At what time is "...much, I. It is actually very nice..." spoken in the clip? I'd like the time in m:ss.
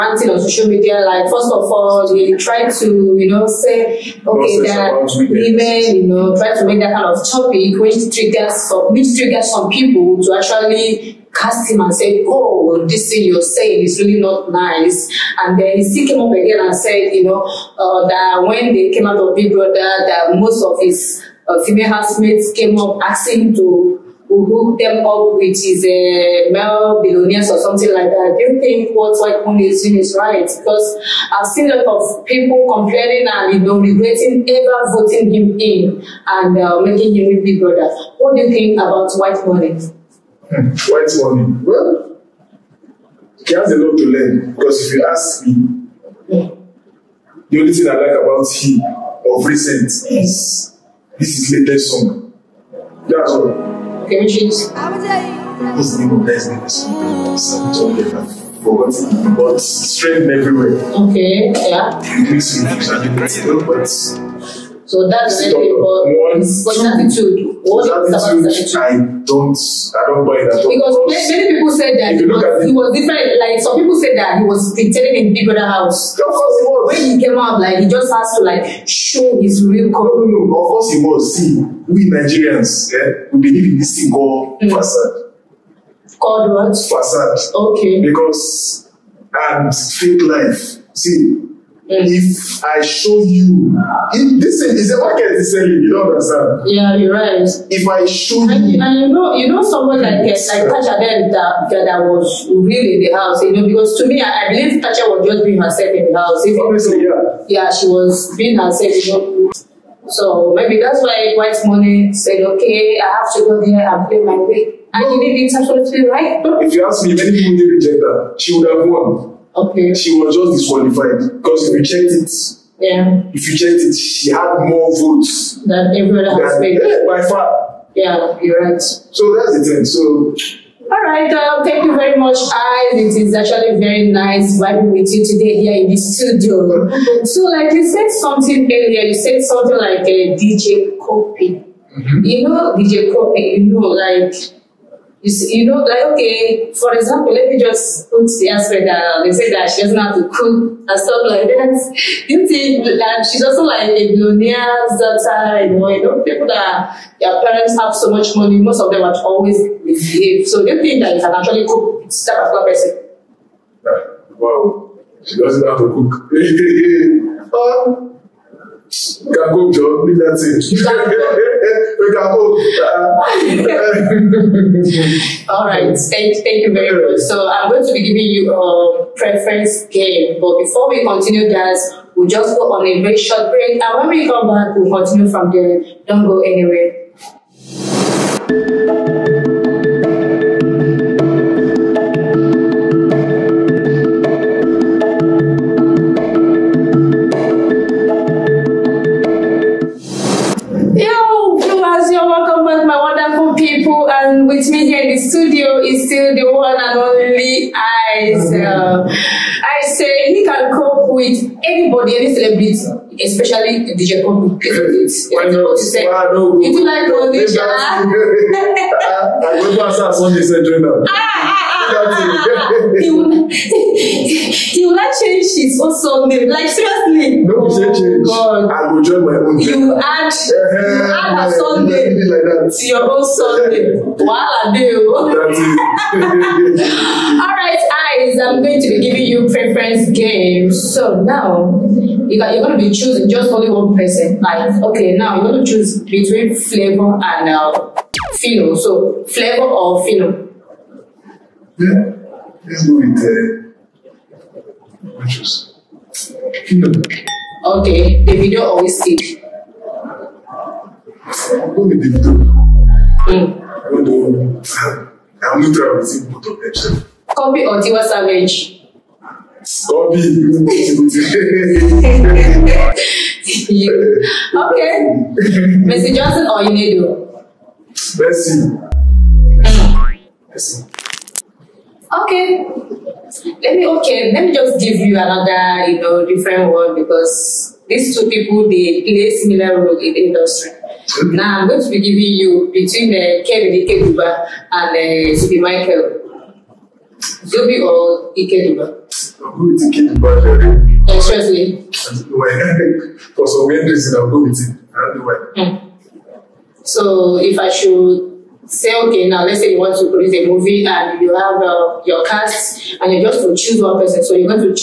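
2:12.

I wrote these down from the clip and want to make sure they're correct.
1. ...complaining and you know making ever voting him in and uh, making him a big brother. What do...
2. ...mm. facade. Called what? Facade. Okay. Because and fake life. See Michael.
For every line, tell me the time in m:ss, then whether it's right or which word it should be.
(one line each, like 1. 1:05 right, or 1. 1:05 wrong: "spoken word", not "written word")
1. 0:32 wrong: "regretting", not "making"
2. 1:24 wrong: "Yes", not "Michael".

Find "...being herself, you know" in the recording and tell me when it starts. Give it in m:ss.
1:48.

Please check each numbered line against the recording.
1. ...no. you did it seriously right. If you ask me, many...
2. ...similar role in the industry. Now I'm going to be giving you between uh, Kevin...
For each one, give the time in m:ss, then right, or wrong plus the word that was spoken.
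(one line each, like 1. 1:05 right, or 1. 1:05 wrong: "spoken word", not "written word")
1. 1:55 wrong: "absolutely", not "seriously"
2. 4:49 right.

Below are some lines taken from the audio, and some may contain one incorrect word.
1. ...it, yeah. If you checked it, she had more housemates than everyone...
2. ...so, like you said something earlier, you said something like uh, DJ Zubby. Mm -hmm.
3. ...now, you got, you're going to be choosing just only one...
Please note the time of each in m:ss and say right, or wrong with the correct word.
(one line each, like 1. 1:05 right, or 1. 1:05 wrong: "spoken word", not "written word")
1. 2:02 wrong: "votes", not "housemates"
2. 2:17 wrong: "Cuppy", not "Zubby"
3. 4:01 right.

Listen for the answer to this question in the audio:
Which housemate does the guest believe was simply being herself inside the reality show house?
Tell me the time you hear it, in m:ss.
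1:44.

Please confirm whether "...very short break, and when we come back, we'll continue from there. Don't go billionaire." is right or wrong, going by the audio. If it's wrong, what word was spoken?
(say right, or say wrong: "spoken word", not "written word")
wrong: "anywhere", not "billionaire".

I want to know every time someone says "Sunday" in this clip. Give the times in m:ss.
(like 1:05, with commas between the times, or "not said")
3:40.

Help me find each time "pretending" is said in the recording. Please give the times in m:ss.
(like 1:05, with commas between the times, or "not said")
1:14.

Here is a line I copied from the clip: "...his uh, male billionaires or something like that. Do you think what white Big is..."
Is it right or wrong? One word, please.
wrong.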